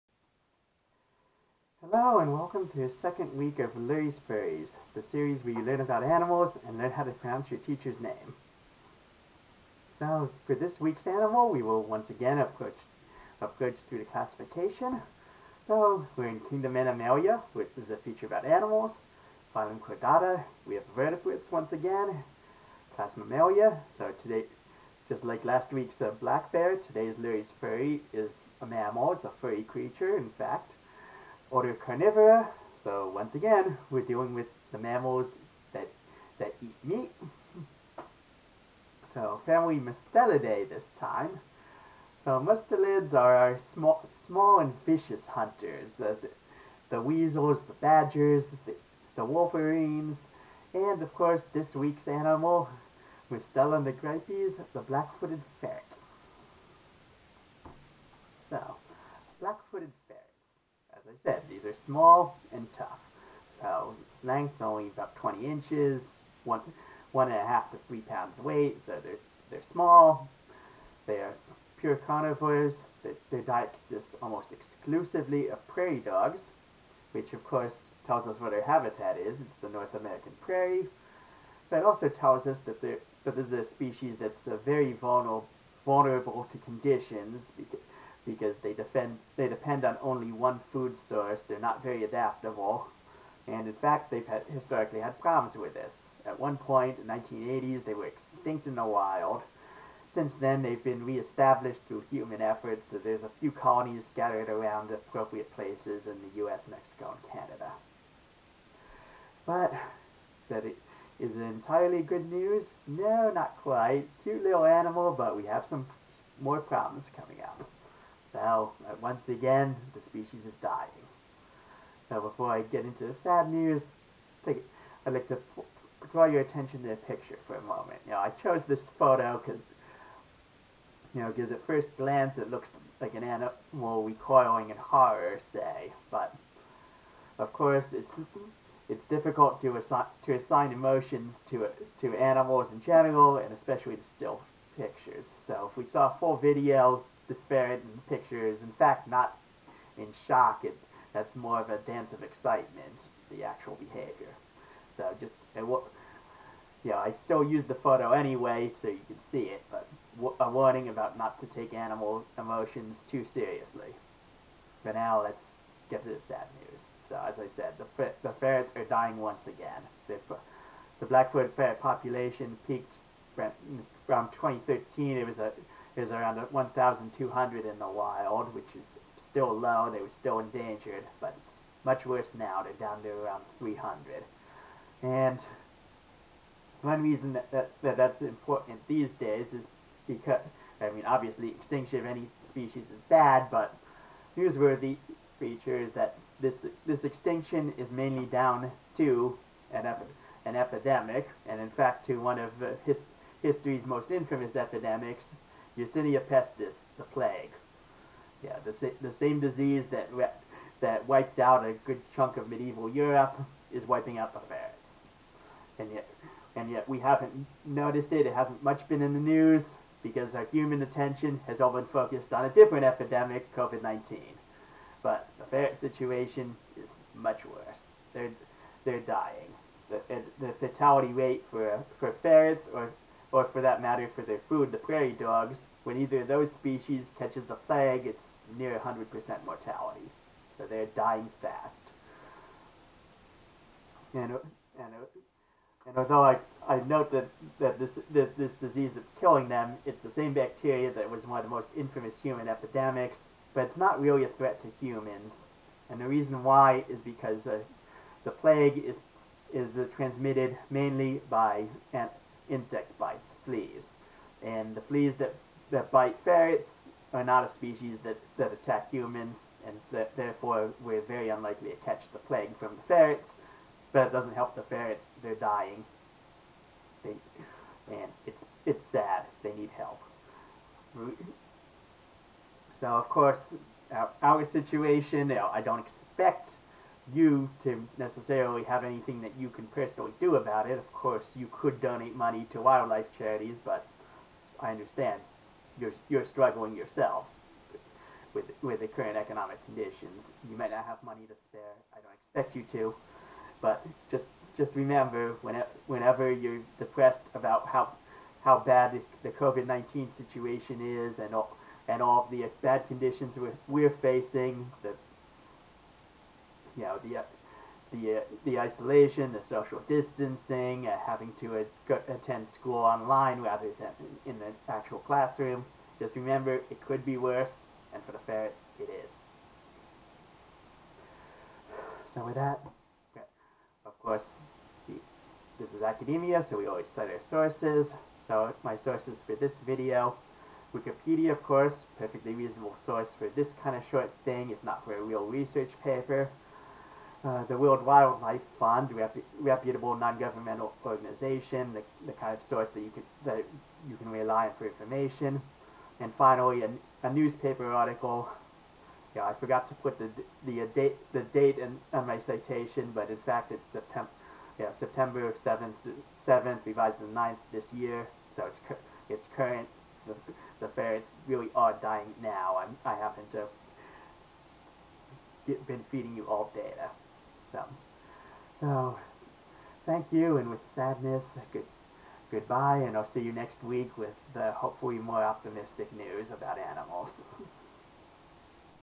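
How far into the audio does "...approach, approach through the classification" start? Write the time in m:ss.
0:12.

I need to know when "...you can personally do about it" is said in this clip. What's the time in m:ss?
4:49.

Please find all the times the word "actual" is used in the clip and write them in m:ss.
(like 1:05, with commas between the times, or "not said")
2:33, 5:24.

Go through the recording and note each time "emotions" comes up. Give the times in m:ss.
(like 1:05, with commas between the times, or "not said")
2:20, 2:42.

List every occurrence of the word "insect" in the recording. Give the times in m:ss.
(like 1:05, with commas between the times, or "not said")
4:22.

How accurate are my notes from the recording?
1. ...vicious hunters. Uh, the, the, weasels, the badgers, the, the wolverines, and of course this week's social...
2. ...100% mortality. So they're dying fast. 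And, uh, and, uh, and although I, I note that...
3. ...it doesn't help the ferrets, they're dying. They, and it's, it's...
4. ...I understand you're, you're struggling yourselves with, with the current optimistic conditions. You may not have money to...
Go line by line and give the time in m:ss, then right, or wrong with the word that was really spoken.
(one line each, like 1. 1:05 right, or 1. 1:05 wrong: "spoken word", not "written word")
1. 0:44 wrong: "animal", not "social"
2. 3:58 right
3. 4:34 right
4. 4:54 wrong: "economic", not "optimistic".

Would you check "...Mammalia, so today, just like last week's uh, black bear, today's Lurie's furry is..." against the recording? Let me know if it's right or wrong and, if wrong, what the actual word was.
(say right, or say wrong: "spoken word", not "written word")
right.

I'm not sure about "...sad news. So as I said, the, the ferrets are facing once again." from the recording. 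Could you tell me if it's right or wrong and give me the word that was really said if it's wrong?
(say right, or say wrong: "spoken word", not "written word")
wrong: "dying", not "facing".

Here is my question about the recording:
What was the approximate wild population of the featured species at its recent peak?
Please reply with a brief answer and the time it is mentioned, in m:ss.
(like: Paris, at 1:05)
1,200, at 2:56.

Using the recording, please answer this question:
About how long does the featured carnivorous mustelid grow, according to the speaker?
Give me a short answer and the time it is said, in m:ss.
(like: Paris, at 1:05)
20 inches, at 1:05.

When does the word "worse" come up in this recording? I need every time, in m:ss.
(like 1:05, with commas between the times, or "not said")
3:02, 3:47, 5:27.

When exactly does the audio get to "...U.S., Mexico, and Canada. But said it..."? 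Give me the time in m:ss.
1:46.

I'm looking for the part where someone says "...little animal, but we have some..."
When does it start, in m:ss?
1:54.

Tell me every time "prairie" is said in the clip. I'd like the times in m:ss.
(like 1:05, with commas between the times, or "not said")
1:15, 1:20, 3:54.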